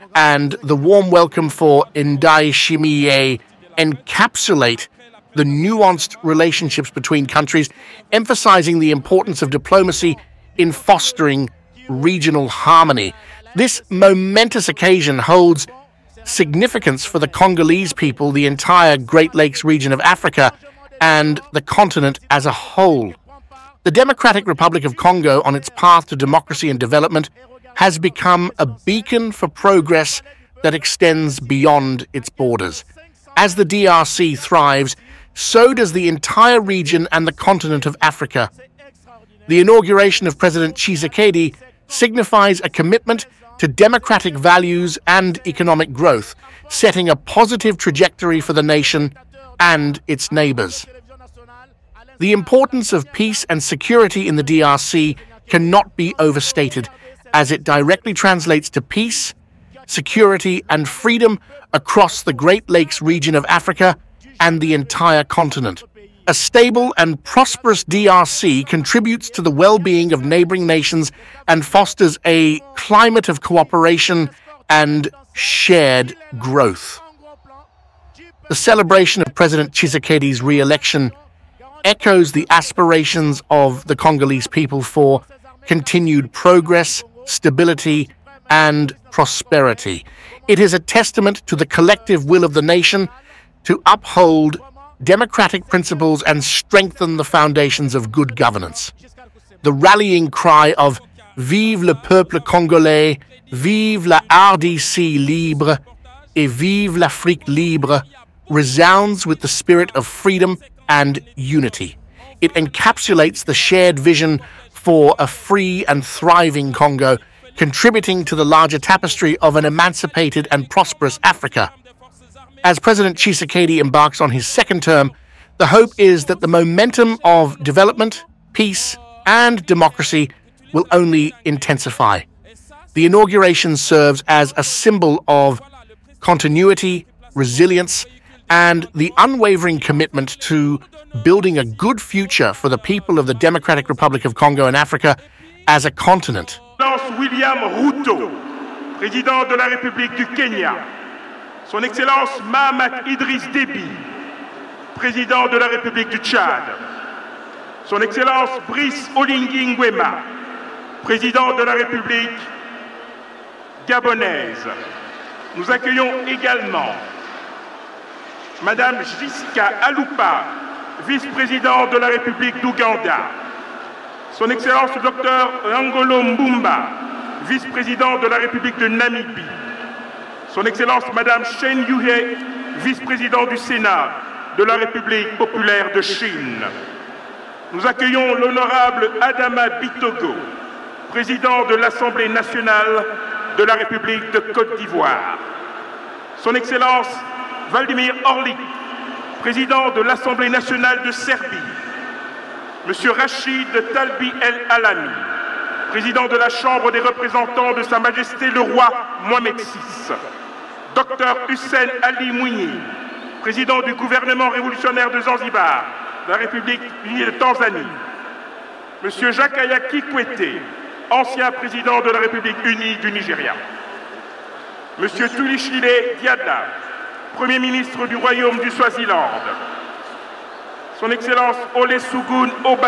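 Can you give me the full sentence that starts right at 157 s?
Son Excellence Brice Oligui Nguema, Président of the Republic Gabonese.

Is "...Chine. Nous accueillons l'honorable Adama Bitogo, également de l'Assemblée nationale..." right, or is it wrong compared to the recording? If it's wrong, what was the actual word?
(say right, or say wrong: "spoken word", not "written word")
wrong: "président", not "également".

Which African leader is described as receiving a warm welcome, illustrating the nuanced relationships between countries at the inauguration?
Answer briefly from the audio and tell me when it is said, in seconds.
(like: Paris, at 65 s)
Ndayishimiye, at 1 s.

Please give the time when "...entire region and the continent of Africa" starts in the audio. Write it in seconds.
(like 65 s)
36 s.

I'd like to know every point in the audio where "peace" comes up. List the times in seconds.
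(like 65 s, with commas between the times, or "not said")
53 s, 58 s, 128 s.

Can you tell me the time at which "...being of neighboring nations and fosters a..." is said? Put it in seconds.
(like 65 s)
69 s.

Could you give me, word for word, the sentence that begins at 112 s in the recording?
It encapsulates the shared vision for a free and thriving Congo, contributing to the larger tapestry of an emancipated and prosperous Africa.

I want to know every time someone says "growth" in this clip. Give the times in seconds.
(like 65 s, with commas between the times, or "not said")
45 s, 76 s.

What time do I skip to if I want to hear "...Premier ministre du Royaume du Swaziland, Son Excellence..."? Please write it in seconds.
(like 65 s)
227 s.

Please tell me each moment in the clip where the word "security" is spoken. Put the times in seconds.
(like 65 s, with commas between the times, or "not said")
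53 s, 59 s.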